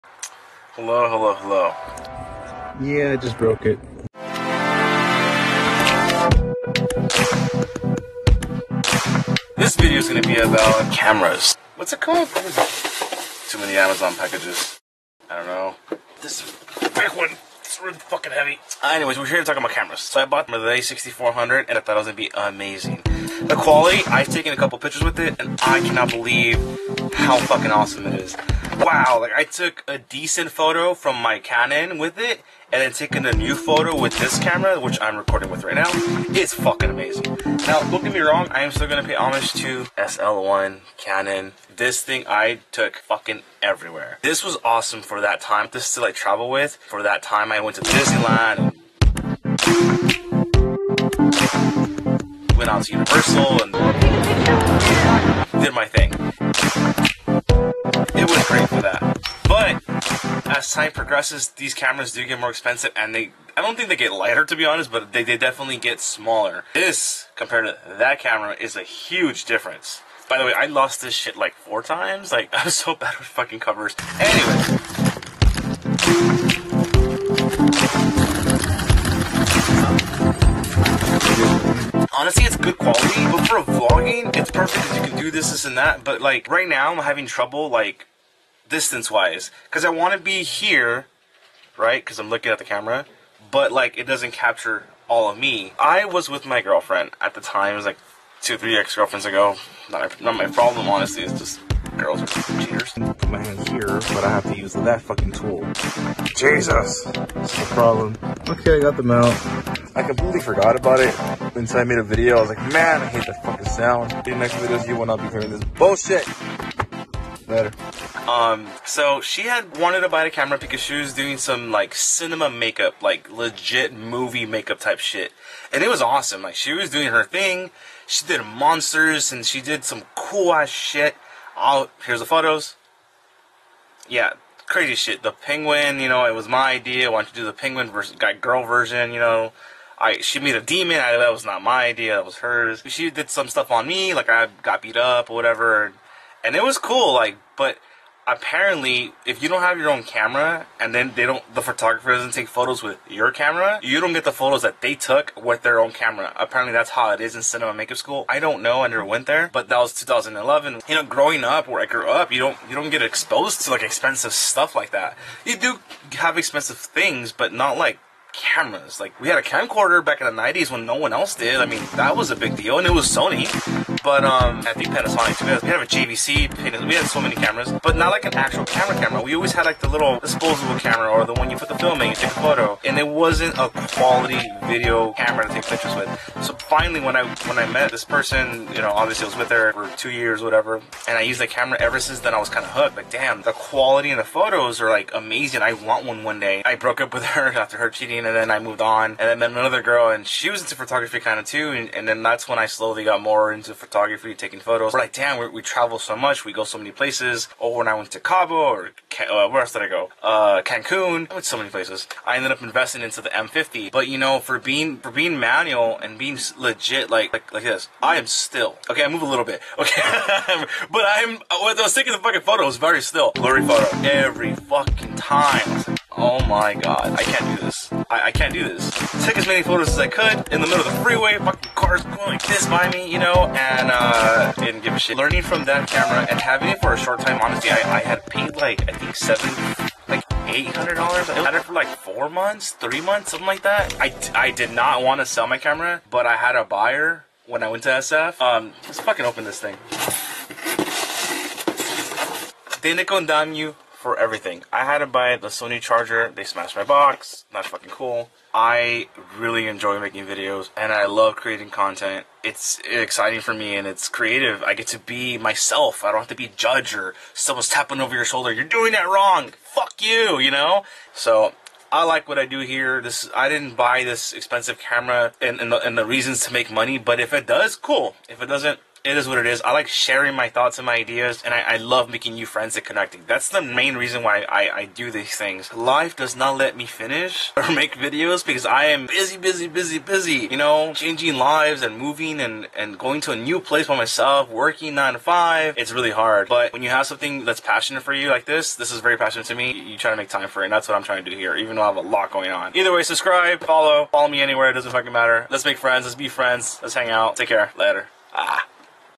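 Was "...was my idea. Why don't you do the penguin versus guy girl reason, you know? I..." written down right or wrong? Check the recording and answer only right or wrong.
wrong.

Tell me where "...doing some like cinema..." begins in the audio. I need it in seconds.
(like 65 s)
121 s.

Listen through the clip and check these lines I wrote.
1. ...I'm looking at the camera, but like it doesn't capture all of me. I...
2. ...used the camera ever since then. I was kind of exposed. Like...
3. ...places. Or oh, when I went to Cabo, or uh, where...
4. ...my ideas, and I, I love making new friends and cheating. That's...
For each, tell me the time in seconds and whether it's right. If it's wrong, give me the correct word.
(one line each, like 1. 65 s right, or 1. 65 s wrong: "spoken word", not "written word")
1. 92 s right
2. 191 s wrong: "hooked", not "exposed"
3. 206 s right
4. 280 s wrong: "connecting", not "cheating".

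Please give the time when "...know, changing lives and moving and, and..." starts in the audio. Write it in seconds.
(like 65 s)
290 s.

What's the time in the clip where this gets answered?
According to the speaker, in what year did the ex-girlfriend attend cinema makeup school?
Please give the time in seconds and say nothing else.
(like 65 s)
159 s.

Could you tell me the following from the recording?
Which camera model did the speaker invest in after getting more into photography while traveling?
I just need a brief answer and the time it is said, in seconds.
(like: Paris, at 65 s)
M50, at 213 s.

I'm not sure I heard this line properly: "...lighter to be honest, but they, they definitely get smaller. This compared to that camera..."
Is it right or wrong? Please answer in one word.
right.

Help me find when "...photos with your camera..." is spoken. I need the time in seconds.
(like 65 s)
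152 s.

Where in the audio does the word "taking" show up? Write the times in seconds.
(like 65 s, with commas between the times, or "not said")
32 s, 204 s, 221 s.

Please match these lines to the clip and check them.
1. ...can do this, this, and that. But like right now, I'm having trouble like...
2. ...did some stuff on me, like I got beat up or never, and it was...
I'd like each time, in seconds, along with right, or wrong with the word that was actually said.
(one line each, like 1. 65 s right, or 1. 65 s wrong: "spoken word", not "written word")
1. 85 s right
2. 143 s wrong: "whatever", not "never".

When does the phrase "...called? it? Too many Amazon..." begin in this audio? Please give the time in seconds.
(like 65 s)
11 s.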